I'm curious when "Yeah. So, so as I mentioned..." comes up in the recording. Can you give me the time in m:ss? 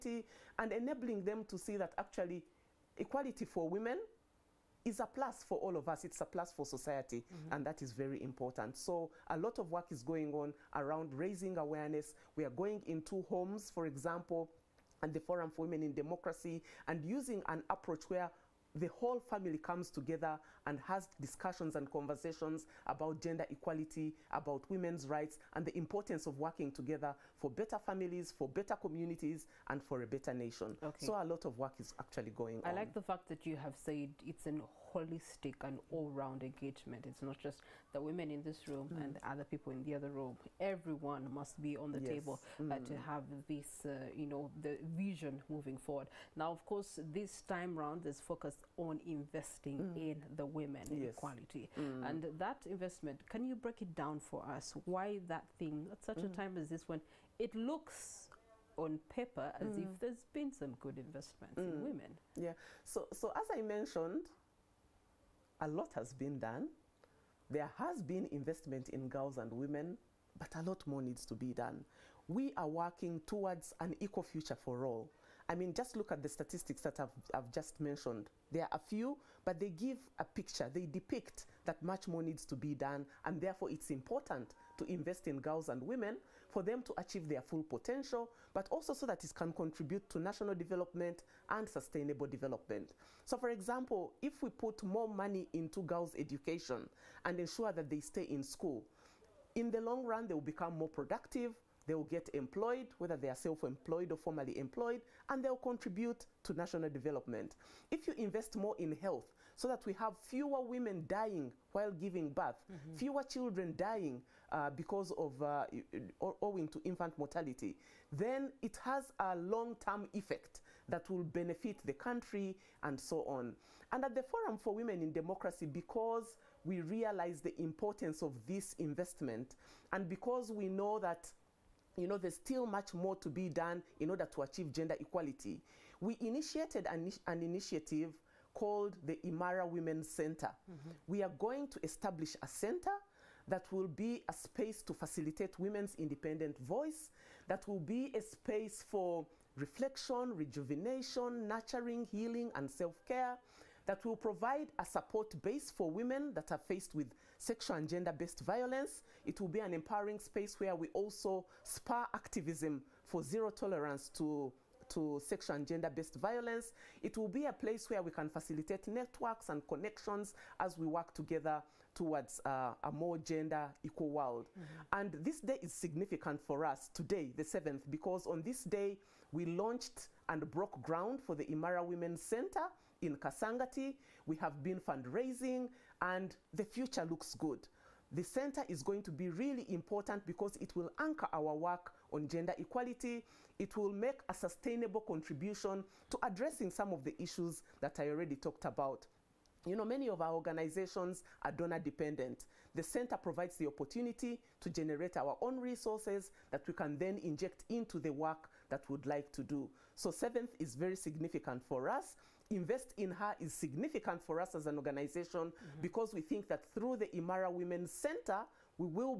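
1:02.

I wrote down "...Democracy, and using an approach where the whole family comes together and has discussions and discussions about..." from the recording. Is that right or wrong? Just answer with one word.
wrong.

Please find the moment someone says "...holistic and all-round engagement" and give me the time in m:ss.
0:34.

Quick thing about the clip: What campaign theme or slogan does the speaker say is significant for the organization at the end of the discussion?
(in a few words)
Invest in Her.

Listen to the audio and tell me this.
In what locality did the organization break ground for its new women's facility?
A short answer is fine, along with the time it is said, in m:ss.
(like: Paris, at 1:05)
Kasangati, at 3:03.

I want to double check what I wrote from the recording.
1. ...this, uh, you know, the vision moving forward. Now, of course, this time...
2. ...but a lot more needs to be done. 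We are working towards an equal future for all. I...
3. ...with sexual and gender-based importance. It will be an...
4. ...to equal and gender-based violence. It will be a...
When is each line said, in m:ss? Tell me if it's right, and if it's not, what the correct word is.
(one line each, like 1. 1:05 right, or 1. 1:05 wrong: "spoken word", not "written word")
1. 0:43 right
2. 1:10 right
3. 2:36 wrong: "violence", not "importance"
4. 2:44 wrong: "sexual", not "equal".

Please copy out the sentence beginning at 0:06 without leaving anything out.
It's a plus for society, mm -hmm.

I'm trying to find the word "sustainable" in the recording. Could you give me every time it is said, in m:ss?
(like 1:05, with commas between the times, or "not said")
1:31, 3:14.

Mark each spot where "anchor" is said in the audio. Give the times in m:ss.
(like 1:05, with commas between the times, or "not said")
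3:10.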